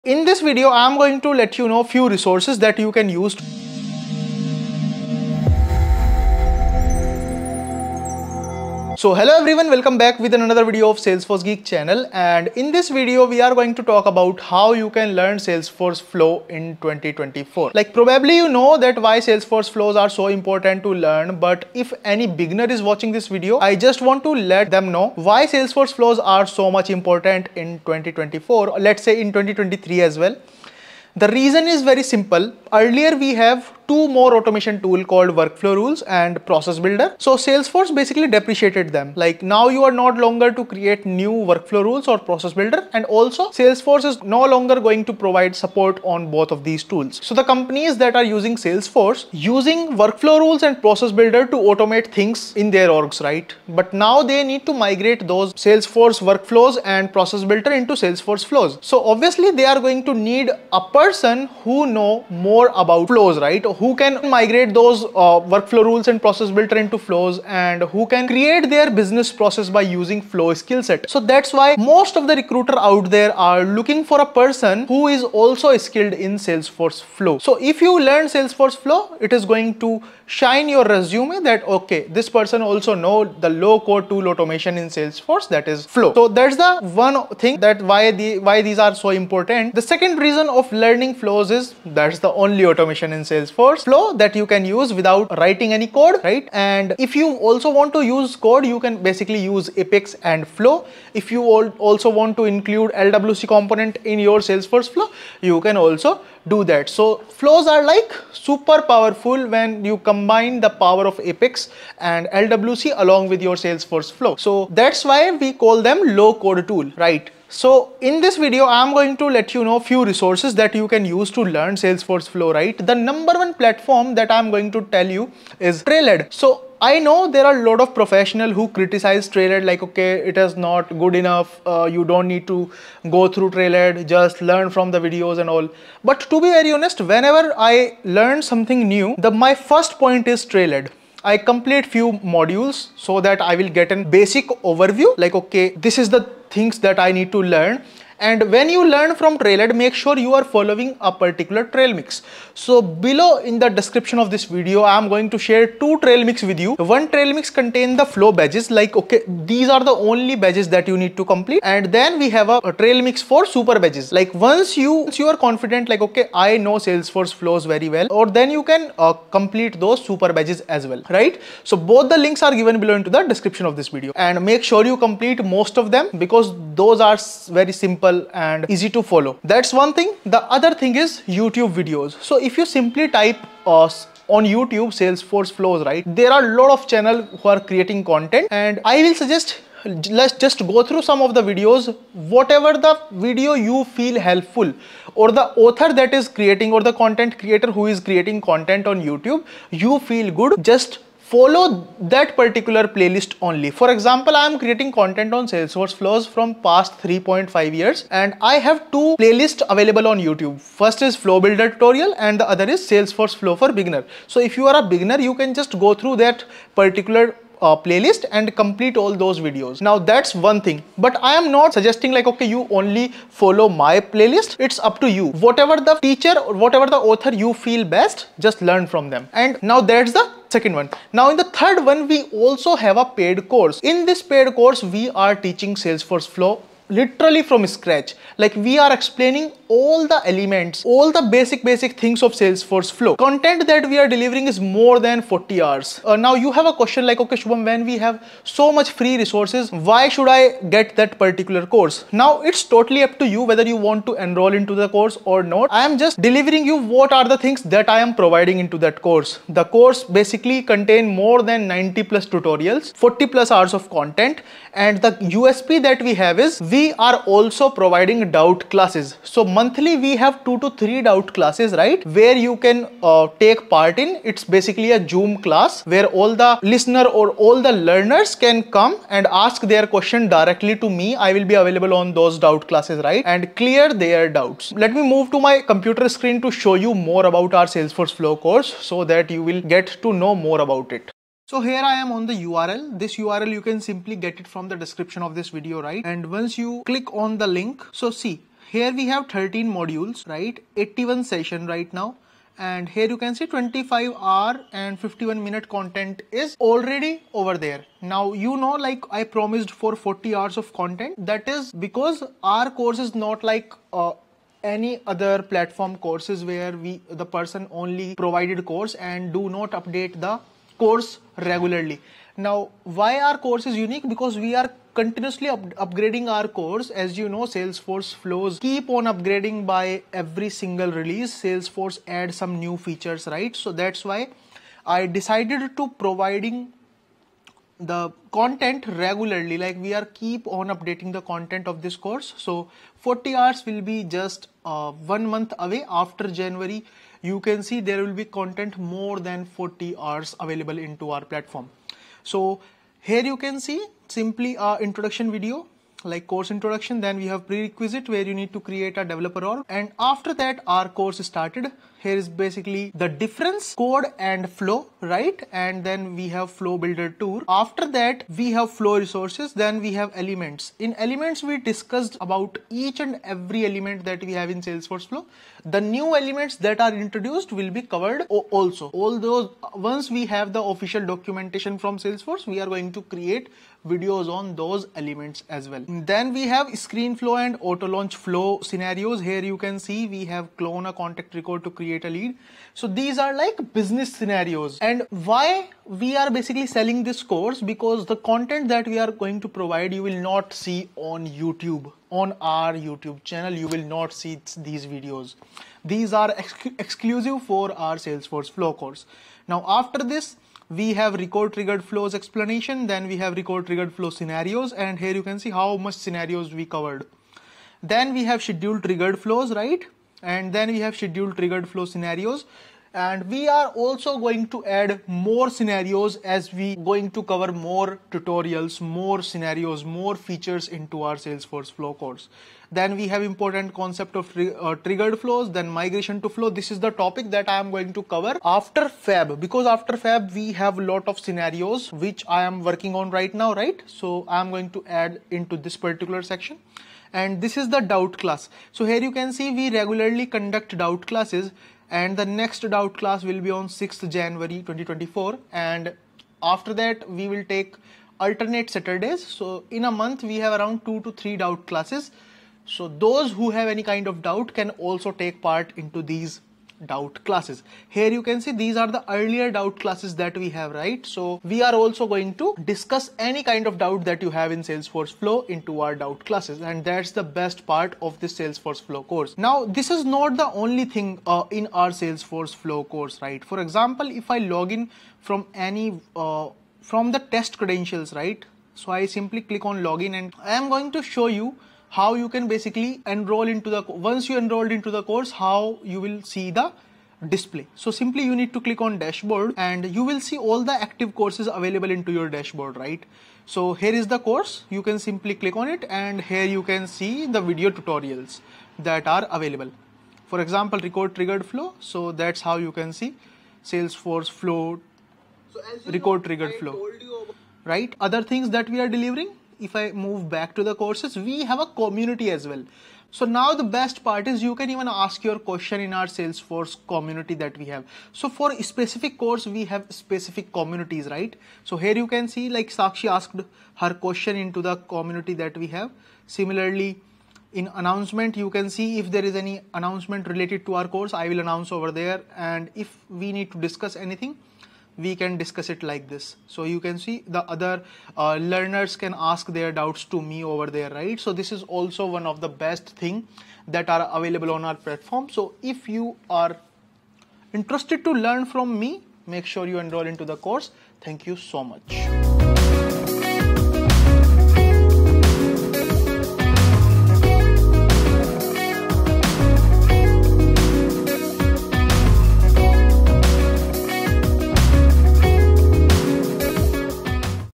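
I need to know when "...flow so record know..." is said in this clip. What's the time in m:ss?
8:34.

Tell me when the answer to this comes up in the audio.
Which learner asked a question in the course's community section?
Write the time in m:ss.
8:52.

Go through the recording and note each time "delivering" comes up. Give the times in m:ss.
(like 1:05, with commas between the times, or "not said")
4:04, 4:16, 8:38.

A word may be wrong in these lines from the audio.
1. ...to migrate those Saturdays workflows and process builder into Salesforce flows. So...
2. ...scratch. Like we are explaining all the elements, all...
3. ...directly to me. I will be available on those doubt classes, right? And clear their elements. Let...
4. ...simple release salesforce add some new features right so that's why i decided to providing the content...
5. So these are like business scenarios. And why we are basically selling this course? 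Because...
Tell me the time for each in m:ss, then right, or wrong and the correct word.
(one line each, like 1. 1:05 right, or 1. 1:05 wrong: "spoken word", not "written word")
1. 0:54 wrong: "Salesforce", not "Saturdays"
2. 3:57 right
3. 4:40 wrong: "doubts", not "elements"
4. 5:30 wrong: "single", not "simple"
5. 6:32 right.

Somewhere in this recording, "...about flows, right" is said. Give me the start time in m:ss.
1:02.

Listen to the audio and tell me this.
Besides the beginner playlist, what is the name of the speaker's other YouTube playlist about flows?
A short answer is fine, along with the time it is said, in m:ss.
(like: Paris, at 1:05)
Flow builder tutorial, at 3:31.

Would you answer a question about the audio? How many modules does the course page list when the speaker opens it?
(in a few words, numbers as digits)
13.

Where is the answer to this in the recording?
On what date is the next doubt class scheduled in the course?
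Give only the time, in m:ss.
7:33.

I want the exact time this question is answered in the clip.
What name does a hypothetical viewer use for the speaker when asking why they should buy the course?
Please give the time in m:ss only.
4:07.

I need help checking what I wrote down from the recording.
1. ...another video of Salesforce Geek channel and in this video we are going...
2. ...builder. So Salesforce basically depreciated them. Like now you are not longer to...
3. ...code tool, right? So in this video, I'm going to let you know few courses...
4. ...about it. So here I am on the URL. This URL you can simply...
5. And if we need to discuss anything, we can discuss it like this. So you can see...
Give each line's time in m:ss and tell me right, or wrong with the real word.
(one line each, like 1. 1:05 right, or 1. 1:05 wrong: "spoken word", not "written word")
1. 0:10 right
2. 0:36 right
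3. 1:56 wrong: "resources", not "courses"
4. 4:50 right
5. 9:02 right.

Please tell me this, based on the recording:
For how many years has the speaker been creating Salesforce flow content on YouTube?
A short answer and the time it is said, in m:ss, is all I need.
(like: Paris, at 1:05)
3.5 years, at 3:27.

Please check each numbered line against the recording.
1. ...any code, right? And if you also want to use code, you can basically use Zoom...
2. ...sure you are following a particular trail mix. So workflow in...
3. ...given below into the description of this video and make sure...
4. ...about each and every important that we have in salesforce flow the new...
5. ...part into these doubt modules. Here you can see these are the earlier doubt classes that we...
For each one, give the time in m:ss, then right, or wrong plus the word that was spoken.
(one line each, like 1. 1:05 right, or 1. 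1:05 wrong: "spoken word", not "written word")
1. 1:35 wrong: "Apex", not "Zoom"
2. 2:29 wrong: "below", not "workflow"
3. 2:52 right
4. 6:12 wrong: "element", not "important"
5. 7:45 wrong: "classes", not "modules".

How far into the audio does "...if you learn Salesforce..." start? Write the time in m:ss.
1:17.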